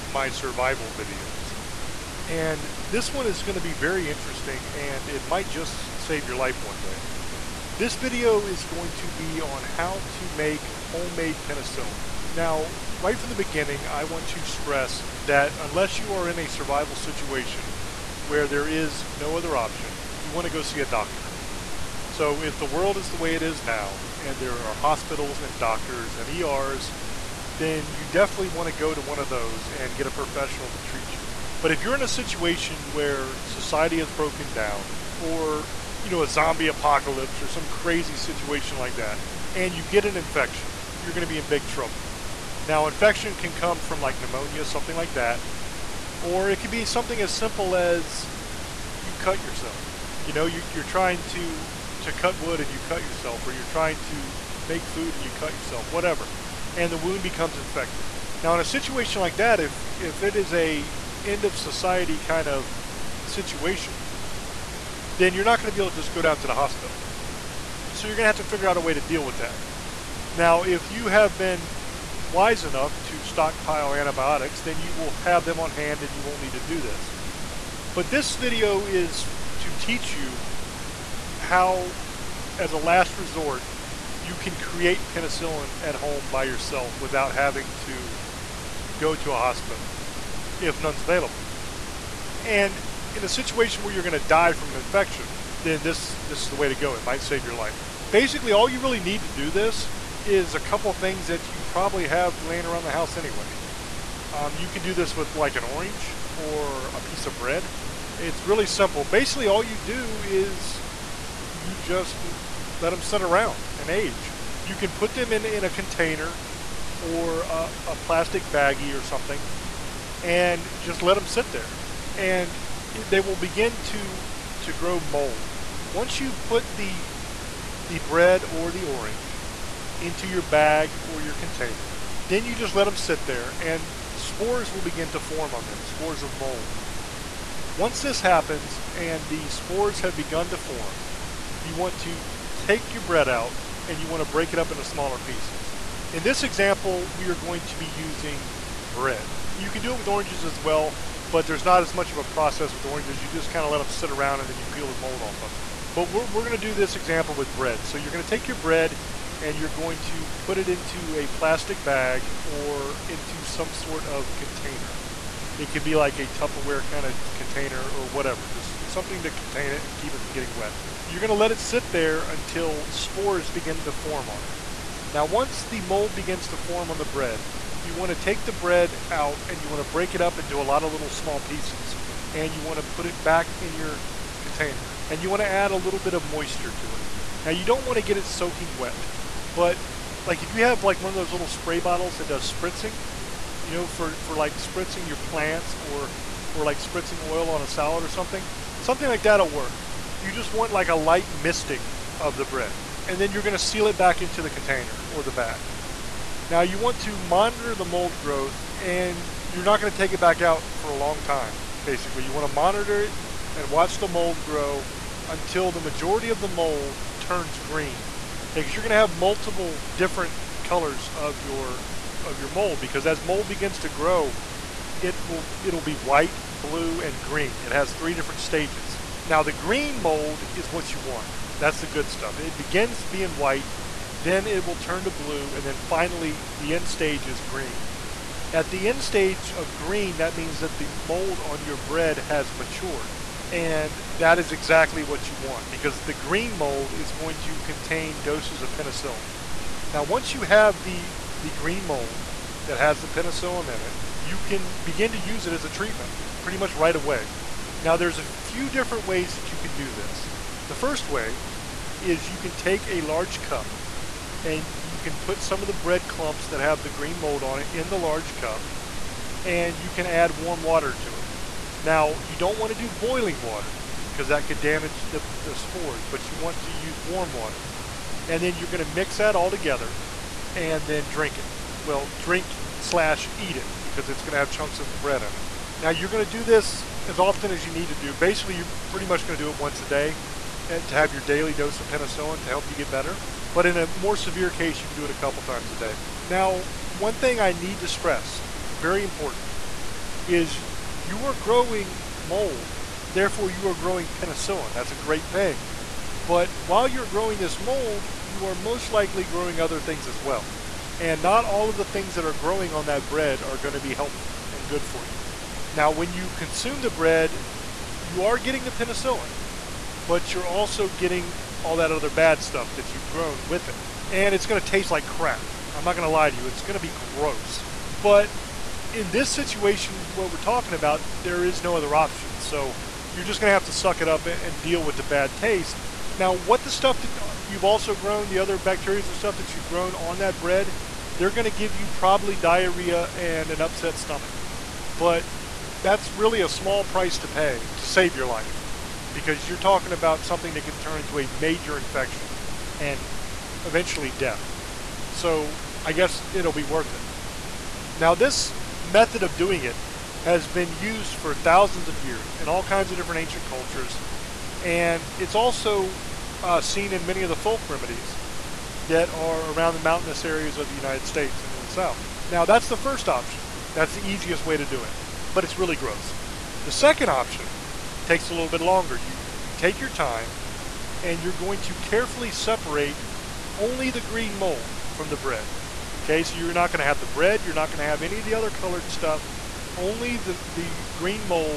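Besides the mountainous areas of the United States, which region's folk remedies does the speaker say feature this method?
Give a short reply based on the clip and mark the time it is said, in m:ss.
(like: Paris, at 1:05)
the South, at 6:11.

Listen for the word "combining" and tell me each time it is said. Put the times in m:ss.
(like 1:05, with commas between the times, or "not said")
not said.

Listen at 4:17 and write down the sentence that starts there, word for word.
Now there's a few different ways that you can do this.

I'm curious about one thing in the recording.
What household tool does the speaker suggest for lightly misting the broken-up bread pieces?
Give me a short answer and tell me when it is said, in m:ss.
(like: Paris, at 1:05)
spray bottles, at 3:11.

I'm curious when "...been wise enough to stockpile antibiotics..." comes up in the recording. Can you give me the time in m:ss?
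1:11.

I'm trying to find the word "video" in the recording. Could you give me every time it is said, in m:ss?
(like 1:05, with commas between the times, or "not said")
0:00, 0:07, 1:18.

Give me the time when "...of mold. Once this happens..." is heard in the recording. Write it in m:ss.
2:16.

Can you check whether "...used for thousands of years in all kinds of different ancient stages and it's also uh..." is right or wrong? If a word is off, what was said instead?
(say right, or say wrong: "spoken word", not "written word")
wrong: "cultures", not "stages".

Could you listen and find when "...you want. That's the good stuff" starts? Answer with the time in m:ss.
3:50.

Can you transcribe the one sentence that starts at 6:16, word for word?
The second option takes a little bit longer.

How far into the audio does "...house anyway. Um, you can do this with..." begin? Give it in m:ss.
1:42.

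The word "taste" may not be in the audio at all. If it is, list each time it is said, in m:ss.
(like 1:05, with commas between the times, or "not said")
5:24, 5:35.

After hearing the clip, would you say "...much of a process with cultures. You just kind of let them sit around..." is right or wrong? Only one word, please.
wrong.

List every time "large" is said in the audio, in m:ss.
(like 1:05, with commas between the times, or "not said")
4:23, 4:27.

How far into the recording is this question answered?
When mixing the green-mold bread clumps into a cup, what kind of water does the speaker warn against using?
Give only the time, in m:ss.
4:32.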